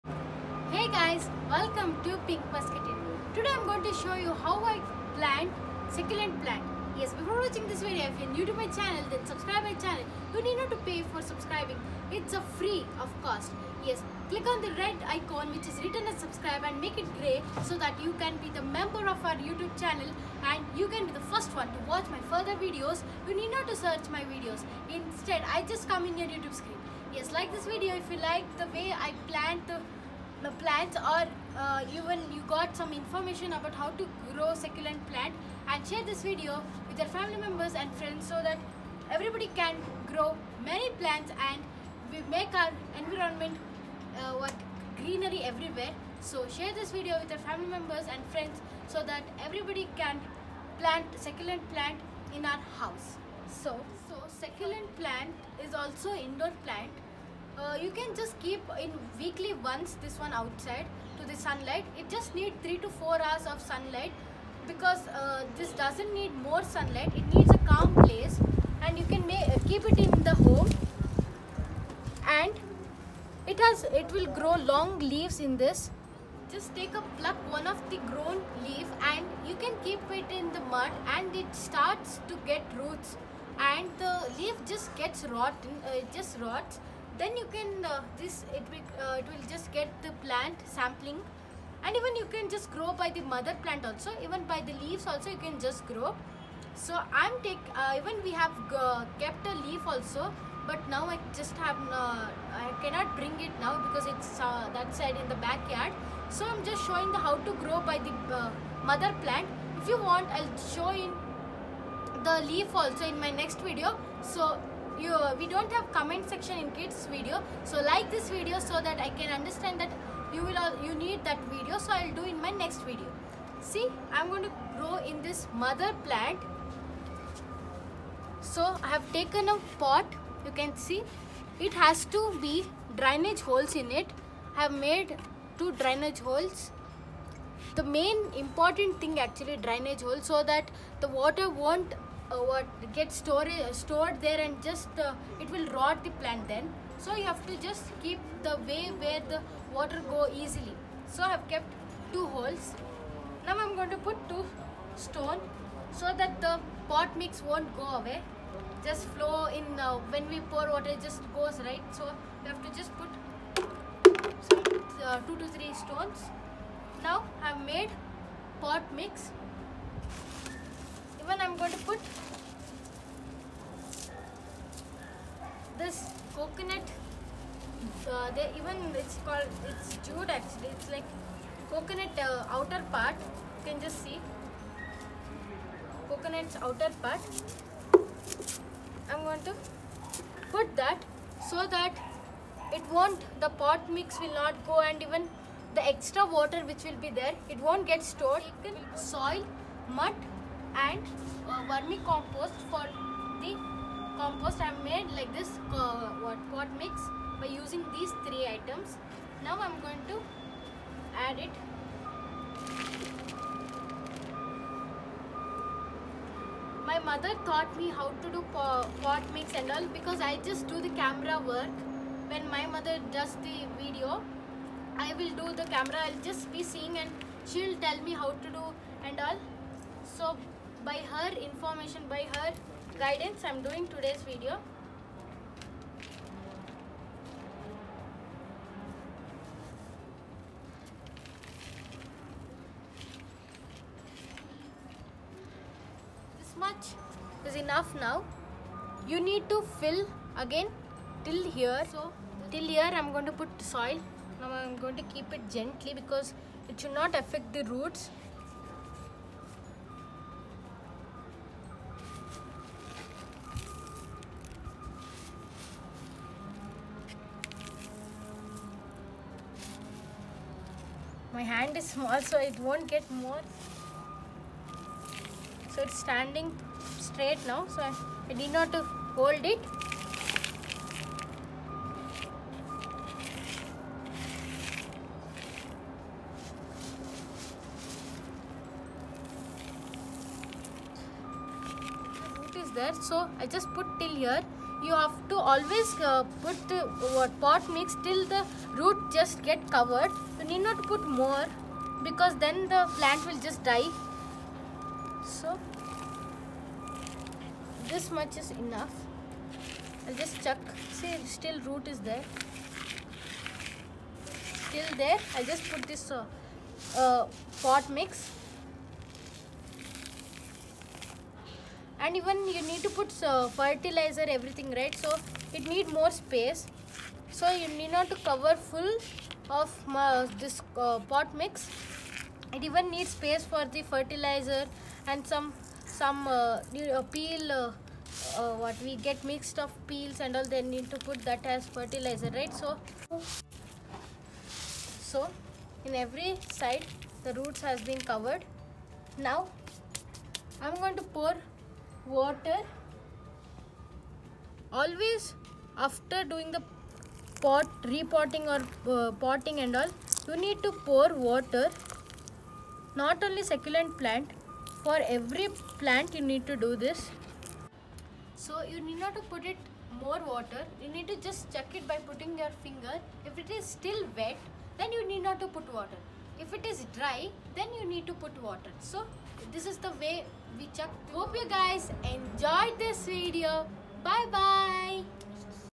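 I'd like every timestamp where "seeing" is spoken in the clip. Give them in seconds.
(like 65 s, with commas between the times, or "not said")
226 s.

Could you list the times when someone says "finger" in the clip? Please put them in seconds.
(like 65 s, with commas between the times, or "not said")
372 s.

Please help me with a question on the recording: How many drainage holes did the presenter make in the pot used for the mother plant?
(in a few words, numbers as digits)
2.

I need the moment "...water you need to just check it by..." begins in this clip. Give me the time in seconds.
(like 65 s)
370 s.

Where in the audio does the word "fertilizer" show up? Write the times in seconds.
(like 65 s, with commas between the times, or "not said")
323 s, 333 s, 341 s.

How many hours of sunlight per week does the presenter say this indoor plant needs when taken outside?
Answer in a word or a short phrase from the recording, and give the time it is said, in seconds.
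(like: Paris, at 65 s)
3 to 4 hours, at 62 s.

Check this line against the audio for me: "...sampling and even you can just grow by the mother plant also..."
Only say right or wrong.
right.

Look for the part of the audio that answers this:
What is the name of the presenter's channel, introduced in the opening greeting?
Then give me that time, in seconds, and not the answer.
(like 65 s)
2 s.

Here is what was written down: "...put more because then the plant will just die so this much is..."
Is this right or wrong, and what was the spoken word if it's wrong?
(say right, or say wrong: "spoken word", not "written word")
right.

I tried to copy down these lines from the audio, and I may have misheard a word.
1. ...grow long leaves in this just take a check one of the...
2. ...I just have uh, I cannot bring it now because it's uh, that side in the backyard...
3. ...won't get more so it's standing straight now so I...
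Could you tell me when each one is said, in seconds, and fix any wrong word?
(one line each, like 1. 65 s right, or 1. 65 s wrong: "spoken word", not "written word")
1. 74 s wrong: "pluck", not "check"
2. 101 s right
3. 272 s right.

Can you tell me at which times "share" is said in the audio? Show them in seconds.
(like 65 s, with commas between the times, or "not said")
35 s, 46 s.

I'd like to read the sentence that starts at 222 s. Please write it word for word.
When my mother does the video, I will do the camera.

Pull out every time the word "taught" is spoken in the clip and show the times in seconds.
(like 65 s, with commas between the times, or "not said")
217 s.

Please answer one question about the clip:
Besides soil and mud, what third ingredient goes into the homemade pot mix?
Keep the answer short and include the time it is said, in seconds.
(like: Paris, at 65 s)
vermicompost, at 201 s.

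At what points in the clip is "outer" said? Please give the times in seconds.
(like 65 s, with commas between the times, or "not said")
182 s, 186 s.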